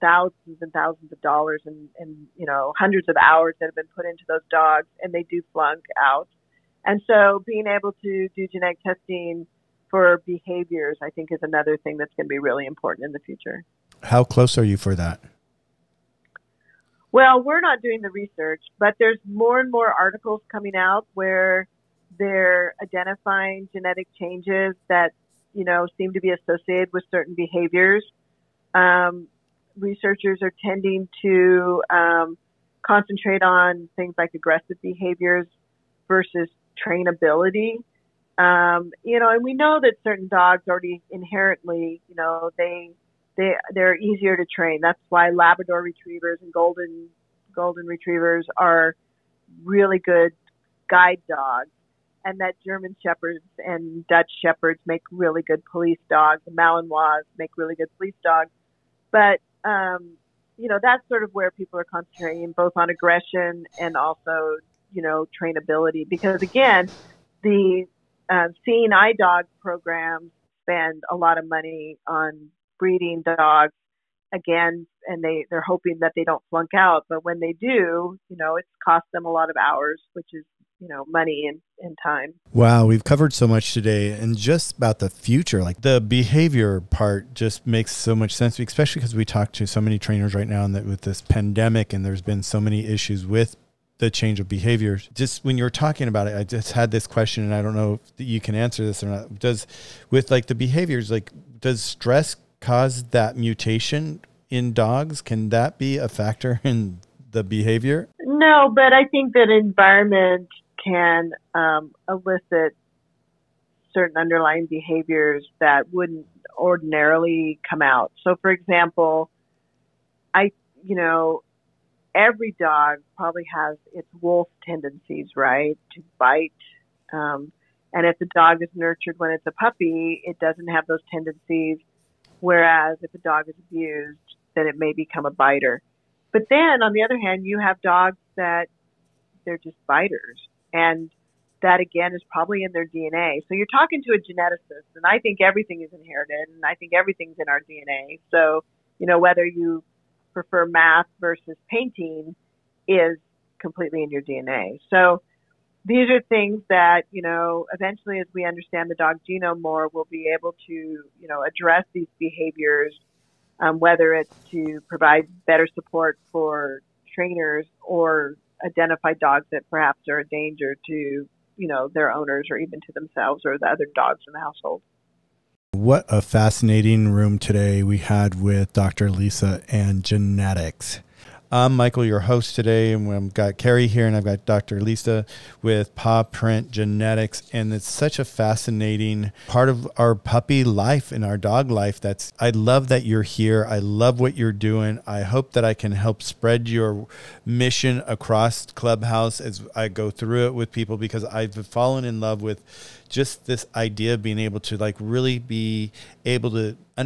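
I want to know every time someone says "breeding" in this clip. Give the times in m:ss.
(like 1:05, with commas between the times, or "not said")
1:12.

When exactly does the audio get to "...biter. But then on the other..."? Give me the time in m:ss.
2:15.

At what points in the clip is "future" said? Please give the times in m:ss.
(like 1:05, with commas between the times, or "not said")
0:13, 1:25.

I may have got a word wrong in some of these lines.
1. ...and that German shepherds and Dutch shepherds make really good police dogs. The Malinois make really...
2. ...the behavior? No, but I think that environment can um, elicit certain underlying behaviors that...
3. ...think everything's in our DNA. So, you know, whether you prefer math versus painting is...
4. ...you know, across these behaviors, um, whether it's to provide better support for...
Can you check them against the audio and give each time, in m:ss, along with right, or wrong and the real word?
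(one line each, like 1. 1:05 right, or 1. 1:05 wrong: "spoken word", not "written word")
1. 0:52 right
2. 1:47 right
3. 2:26 right
4. 2:40 wrong: "address", not "across".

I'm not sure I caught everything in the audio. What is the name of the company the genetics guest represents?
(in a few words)
Paw Print Genetics.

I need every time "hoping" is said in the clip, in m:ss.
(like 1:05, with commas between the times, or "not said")
1:15.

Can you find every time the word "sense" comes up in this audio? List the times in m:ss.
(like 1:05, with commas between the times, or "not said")
1:28.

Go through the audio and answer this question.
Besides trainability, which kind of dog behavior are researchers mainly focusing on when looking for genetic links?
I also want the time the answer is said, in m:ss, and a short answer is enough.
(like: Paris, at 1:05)
aggressive behaviors, at 0:34.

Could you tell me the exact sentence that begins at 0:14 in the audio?
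How close are you for that?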